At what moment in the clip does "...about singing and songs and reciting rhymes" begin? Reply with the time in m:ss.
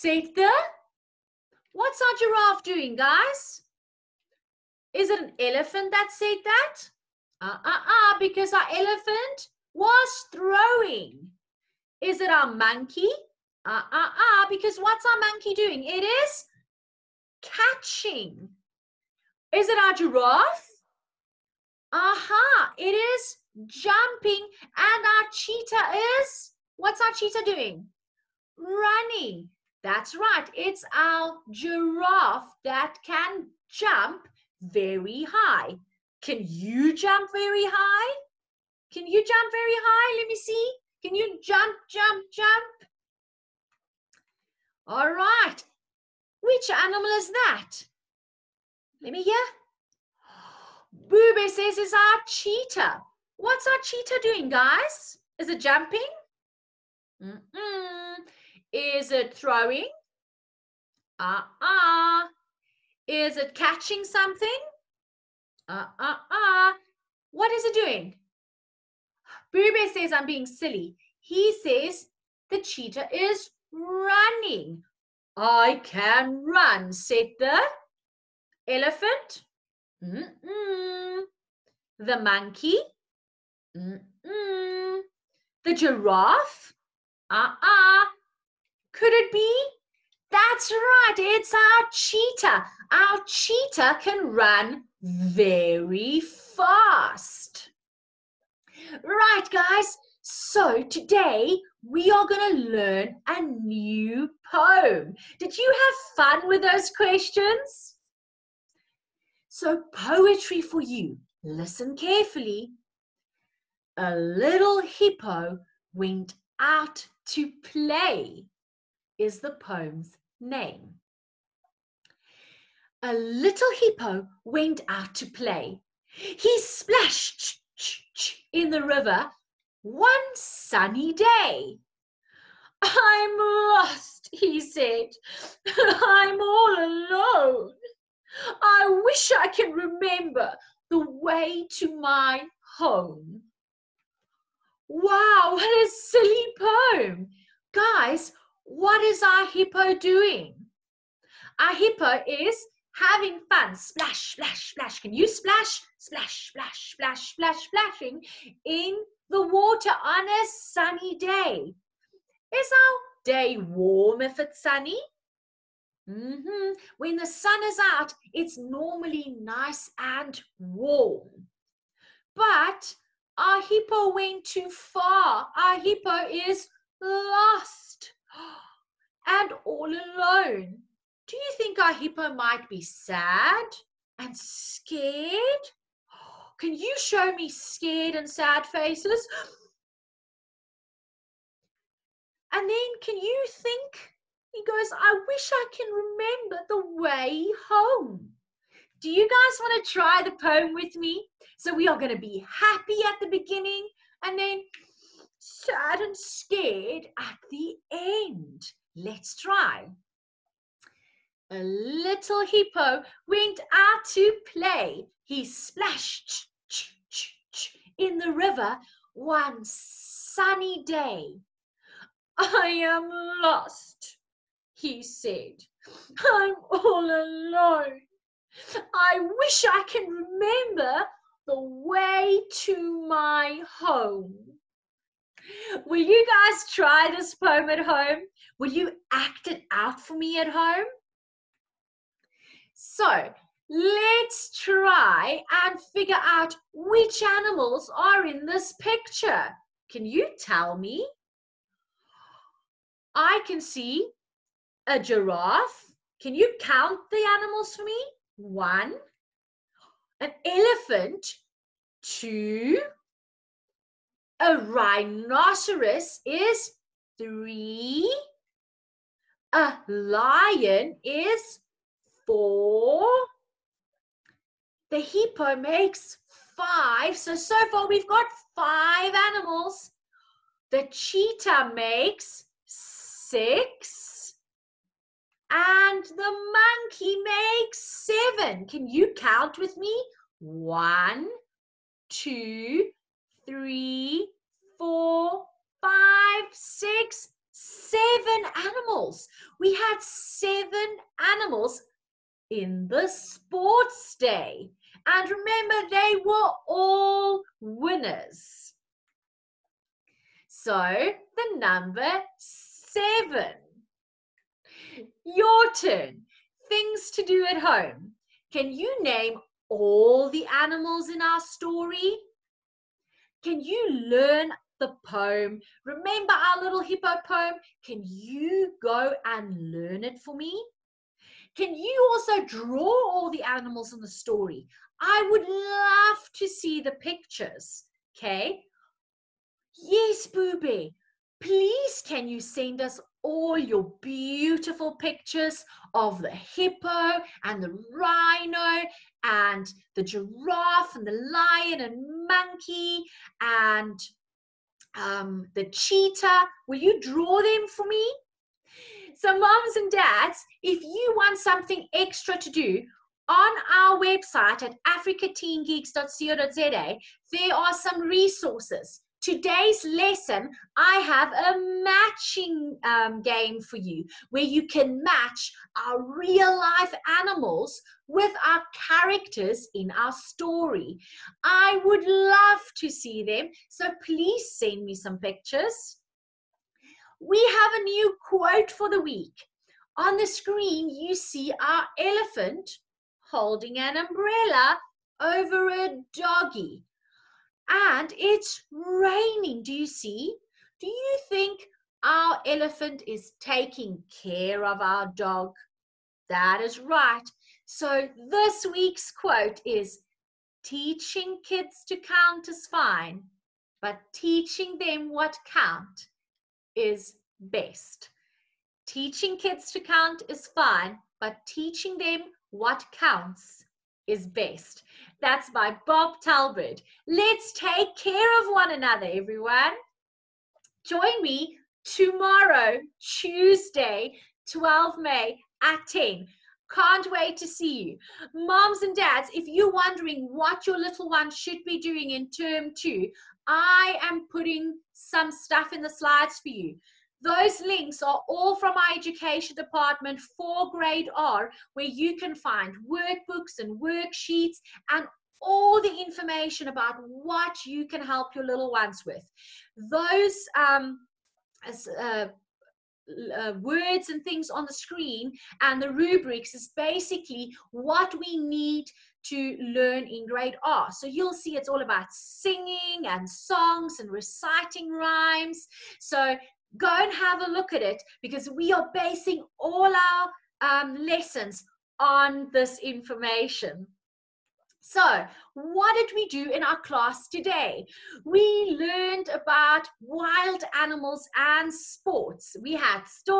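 7:51.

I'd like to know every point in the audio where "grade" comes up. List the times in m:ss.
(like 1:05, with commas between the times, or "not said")
7:30, 7:50.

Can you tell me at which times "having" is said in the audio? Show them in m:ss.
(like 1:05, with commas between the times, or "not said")
2:32.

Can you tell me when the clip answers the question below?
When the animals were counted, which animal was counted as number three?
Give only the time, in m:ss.
4:24.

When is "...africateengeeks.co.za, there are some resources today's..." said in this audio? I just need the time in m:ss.
6:04.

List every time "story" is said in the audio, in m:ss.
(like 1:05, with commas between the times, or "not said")
5:21, 5:34, 6:20.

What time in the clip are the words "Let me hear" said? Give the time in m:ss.
0:49.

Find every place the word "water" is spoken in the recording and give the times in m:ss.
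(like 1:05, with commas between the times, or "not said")
2:39.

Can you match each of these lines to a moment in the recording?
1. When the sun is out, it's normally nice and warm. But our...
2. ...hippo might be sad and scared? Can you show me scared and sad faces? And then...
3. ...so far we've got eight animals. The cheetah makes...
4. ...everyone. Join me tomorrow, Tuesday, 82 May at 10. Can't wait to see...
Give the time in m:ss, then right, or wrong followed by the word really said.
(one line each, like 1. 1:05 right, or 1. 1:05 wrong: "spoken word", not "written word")
1. 2:46 right
2. 3:01 right
3. 4:37 wrong: "five", not "eight"
4. 7:09 wrong: "12", not "82".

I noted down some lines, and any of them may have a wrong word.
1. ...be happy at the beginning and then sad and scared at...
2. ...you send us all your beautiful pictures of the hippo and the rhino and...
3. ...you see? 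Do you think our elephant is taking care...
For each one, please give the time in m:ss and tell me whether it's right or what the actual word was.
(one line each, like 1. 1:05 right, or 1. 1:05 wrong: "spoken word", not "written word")
1. 3:22 right
2. 5:42 right
3. 6:39 right.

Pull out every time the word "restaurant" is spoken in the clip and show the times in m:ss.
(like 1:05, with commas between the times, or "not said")
not said.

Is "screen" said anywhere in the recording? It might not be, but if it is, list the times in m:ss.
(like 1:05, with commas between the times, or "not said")
6:30, 7:44.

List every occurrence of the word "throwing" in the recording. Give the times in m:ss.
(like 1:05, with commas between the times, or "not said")
0:10, 0:59.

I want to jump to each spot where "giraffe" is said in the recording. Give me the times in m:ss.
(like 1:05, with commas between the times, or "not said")
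0:02, 0:19, 0:31, 1:25, 4:14, 5:50.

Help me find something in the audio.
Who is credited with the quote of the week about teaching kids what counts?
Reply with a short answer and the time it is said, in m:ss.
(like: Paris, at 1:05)
Bob Talbert, at 7:05.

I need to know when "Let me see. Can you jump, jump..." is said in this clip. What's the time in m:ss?
0:40.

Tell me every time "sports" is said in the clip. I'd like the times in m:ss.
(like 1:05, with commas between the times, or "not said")
5:03, 8:11.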